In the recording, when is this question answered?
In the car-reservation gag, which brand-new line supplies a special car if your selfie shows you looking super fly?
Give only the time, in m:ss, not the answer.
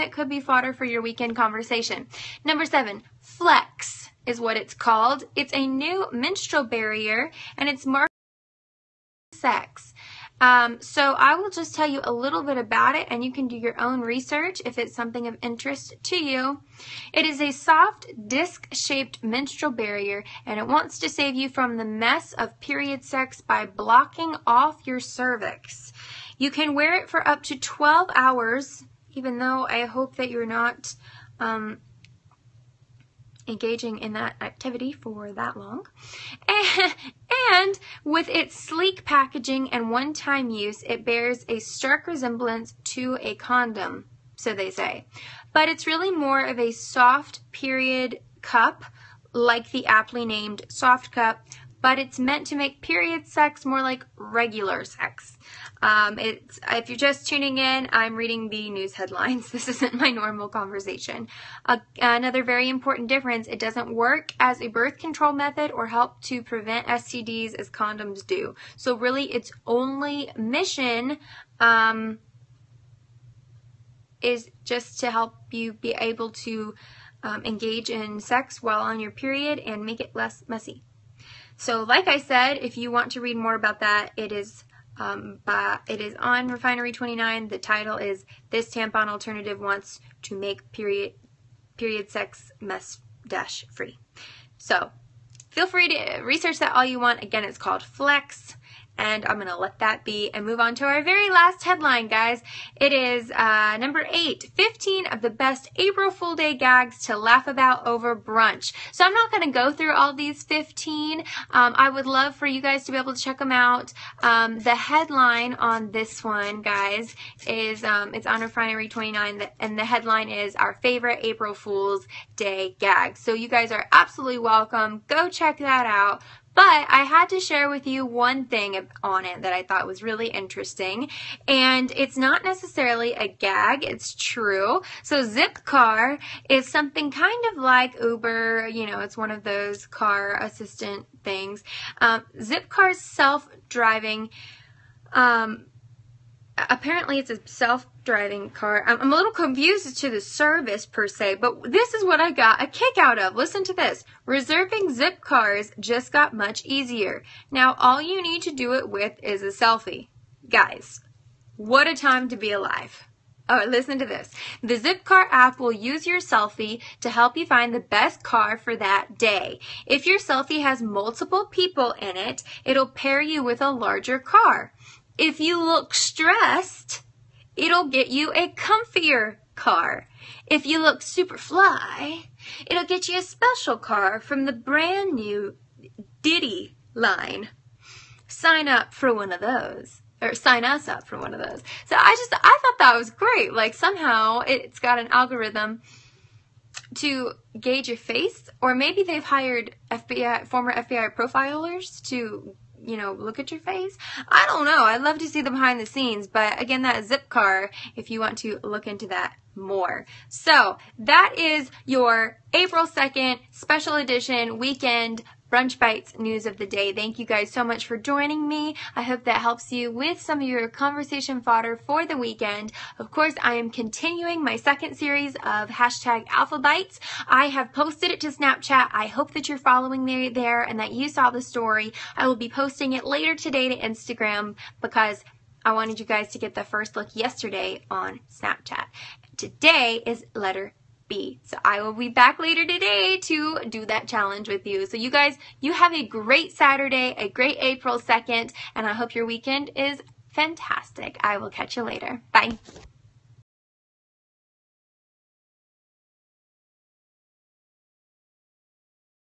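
3:06.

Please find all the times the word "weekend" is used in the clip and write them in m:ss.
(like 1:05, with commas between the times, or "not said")
0:01, 3:34, 3:42, 4:09.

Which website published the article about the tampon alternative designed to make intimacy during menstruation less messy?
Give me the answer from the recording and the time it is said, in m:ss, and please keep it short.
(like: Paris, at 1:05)
Refinery29, at 1:26.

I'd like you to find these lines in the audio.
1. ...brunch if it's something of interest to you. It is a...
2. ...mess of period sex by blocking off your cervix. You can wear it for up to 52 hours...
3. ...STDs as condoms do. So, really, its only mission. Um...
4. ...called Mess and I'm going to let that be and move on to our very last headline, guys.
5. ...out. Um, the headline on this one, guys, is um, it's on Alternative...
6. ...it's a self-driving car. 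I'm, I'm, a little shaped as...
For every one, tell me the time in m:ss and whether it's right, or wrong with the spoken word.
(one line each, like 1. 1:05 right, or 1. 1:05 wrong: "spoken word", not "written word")
1. 0:13 wrong: "research", not "brunch"
2. 0:21 wrong: "12", not "52"
3. 1:06 right
4. 1:37 wrong: "Flex", not "Mess"
5. 1:53 wrong: "Refinery", not "Alternative"
6. 2:27 wrong: "confused", not "shaped".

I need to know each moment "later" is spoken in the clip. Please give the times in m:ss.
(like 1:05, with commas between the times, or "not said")
3:53, 4:02, 4:11.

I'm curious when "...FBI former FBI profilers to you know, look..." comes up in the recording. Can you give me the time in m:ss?
3:19.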